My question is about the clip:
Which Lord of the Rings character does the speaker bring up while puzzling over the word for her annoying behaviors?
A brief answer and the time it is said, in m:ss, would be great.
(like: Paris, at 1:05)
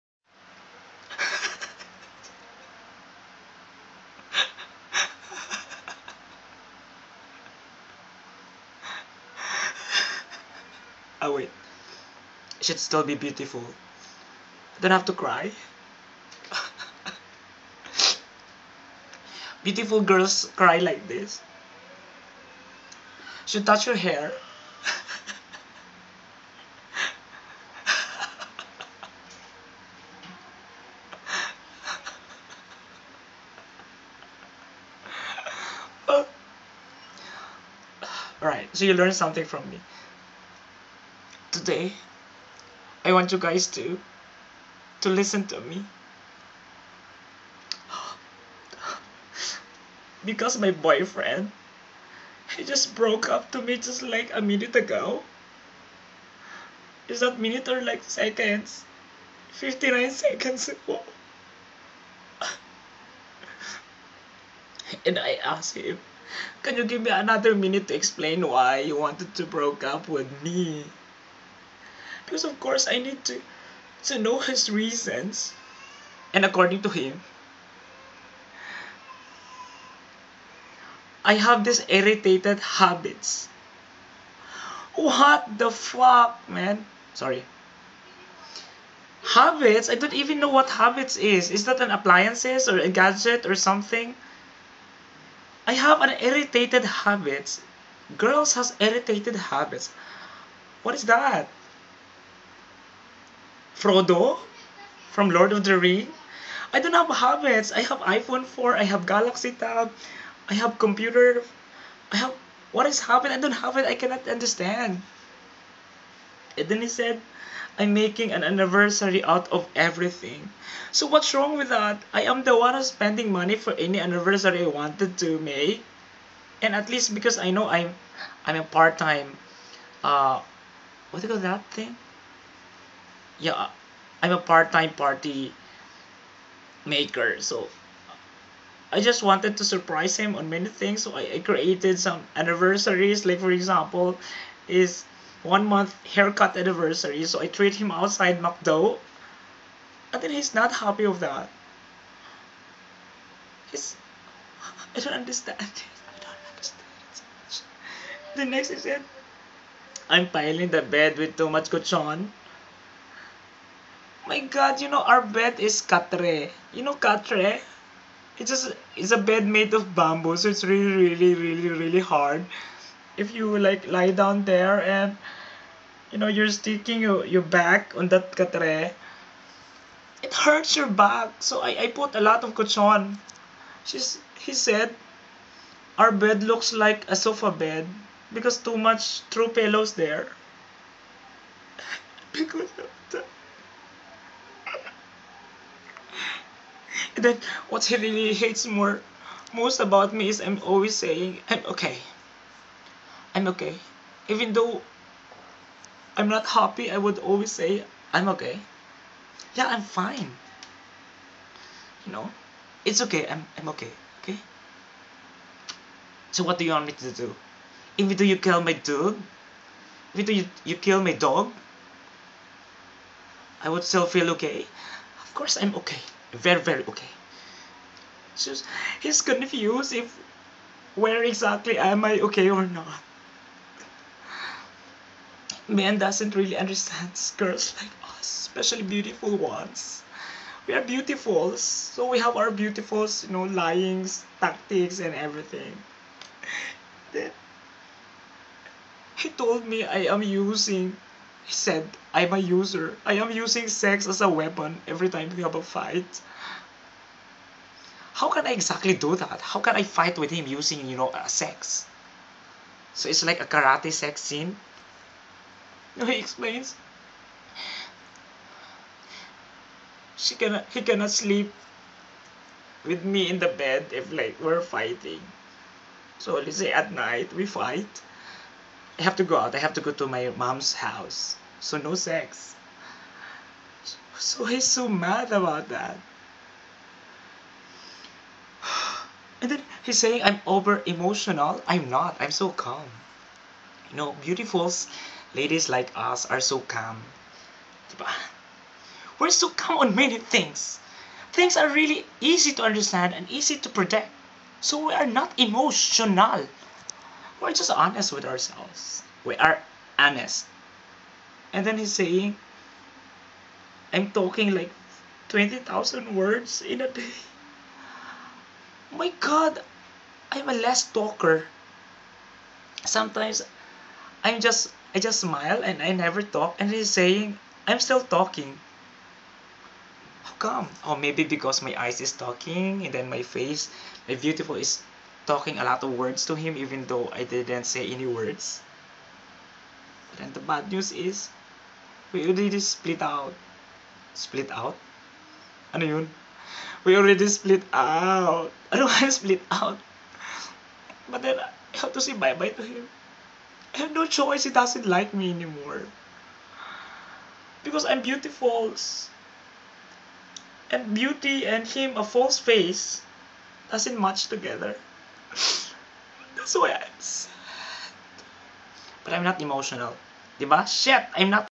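Frodo, at 1:43.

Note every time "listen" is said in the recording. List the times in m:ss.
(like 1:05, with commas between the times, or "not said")
0:45.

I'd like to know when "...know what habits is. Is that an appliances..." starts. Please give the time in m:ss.
1:30.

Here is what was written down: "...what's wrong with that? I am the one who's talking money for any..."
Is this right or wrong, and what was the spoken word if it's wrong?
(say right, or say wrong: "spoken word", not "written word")
wrong: "spending", not "talking".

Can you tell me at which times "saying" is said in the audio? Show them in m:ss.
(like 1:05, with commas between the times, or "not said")
3:20, 4:49, 5:11, 5:26.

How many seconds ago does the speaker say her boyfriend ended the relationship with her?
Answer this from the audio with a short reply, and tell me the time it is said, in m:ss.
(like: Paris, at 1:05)
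59, at 0:59.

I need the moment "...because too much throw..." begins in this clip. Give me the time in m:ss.
3:08.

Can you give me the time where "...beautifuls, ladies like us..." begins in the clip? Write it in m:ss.
4:54.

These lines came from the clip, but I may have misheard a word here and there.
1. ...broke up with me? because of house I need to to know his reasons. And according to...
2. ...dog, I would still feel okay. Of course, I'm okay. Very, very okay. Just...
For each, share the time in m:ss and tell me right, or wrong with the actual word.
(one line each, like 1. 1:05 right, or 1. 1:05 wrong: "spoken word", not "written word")
1. 1:09 wrong: "course", not "house"
2. 3:41 right.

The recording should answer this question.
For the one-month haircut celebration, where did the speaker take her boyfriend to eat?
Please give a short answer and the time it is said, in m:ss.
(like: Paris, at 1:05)
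McDo, at 2:28.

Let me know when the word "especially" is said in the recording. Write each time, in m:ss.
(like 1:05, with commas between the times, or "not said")
3:58.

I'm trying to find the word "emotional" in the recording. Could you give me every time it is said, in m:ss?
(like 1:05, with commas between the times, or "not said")
4:50, 5:05, 6:09.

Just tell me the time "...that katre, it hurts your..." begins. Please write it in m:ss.
2:58.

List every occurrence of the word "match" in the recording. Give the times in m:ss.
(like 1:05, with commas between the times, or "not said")
6:03.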